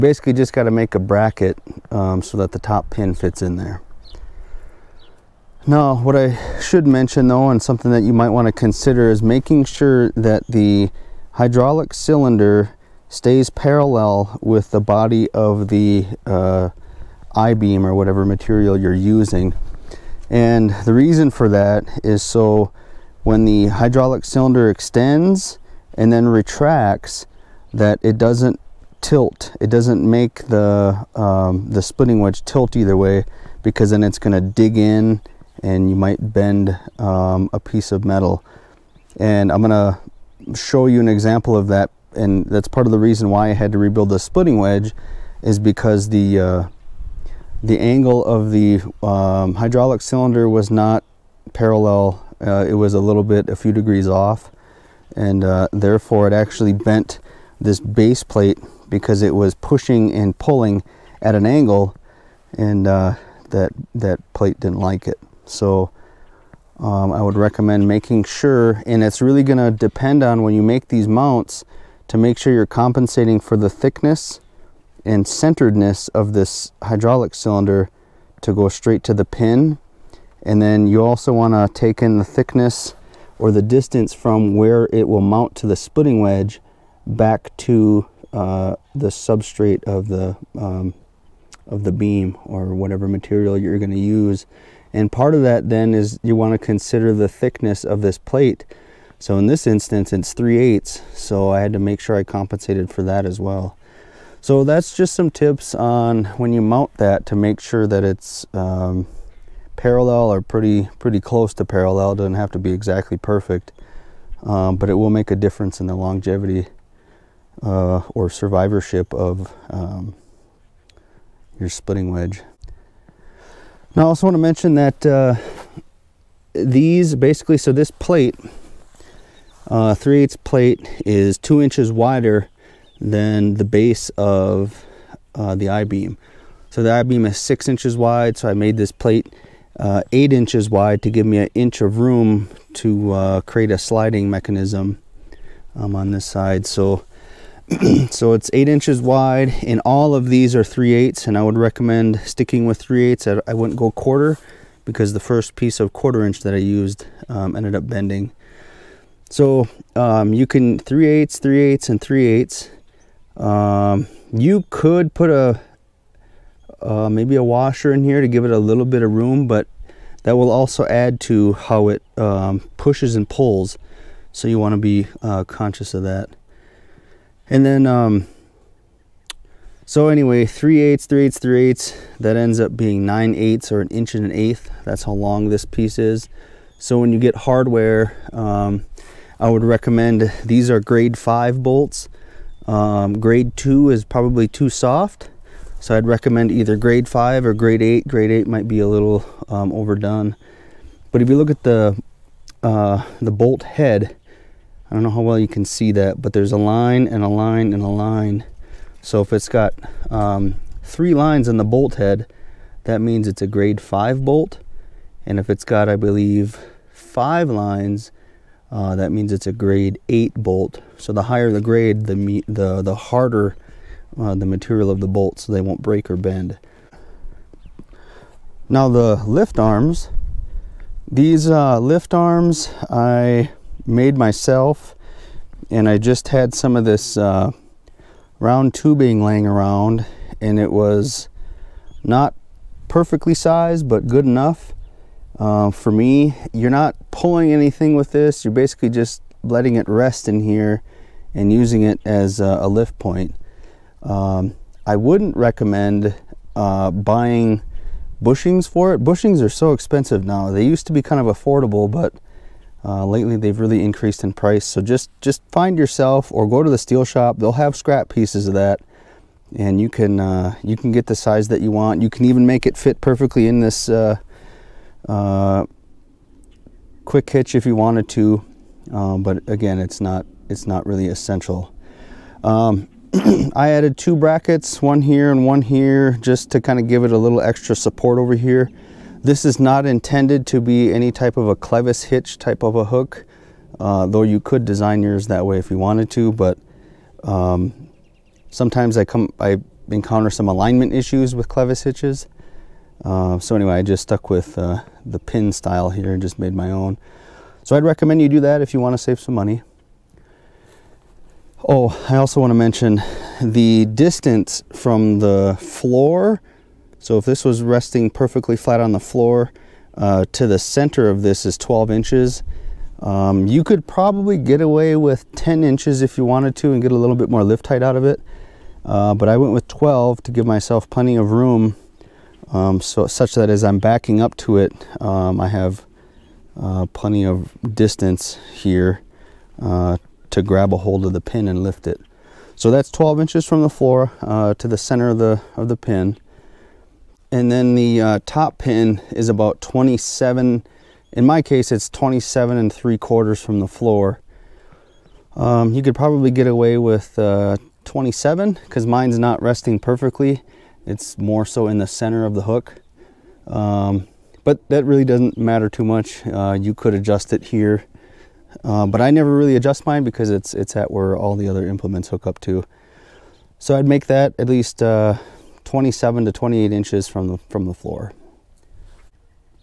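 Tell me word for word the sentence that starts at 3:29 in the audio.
So if it's got um, three lines in the bolt head, that means it's a grade five bolt.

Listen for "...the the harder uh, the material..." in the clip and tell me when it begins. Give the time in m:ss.
3:42.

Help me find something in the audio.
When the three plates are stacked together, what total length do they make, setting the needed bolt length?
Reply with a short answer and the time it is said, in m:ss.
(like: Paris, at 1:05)
1 1/8 inches, at 3:03.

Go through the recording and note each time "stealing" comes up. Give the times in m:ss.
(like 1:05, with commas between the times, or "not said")
not said.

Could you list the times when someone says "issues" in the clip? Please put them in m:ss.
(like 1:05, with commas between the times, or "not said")
5:00.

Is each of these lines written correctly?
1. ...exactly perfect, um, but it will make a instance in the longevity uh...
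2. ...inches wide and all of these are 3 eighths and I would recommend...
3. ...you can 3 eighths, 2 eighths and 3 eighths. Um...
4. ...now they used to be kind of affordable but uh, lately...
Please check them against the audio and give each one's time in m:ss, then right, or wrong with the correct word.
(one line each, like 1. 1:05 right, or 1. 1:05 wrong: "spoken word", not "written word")
1. 1:52 wrong: "difference", not "instance"
2. 2:28 right
3. 2:40 wrong: "3", not "2"
4. 4:20 right.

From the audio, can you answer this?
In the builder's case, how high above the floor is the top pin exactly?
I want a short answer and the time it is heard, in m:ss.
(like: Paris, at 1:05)
27 3/4 inches, at 5:51.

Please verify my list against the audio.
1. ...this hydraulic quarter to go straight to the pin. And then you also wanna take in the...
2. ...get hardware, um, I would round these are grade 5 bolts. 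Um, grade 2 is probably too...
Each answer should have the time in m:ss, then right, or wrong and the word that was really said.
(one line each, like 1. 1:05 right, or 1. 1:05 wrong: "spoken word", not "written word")
1. 1:16 wrong: "cylinder", not "quarter"
2. 3:07 wrong: "recommend", not "round".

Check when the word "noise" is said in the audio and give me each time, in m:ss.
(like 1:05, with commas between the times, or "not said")
not said.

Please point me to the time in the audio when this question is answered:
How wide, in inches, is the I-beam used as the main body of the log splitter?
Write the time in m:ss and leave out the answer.
2:17.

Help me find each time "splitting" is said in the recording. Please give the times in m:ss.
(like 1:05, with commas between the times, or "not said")
0:31, 0:44, 1:25, 2:01.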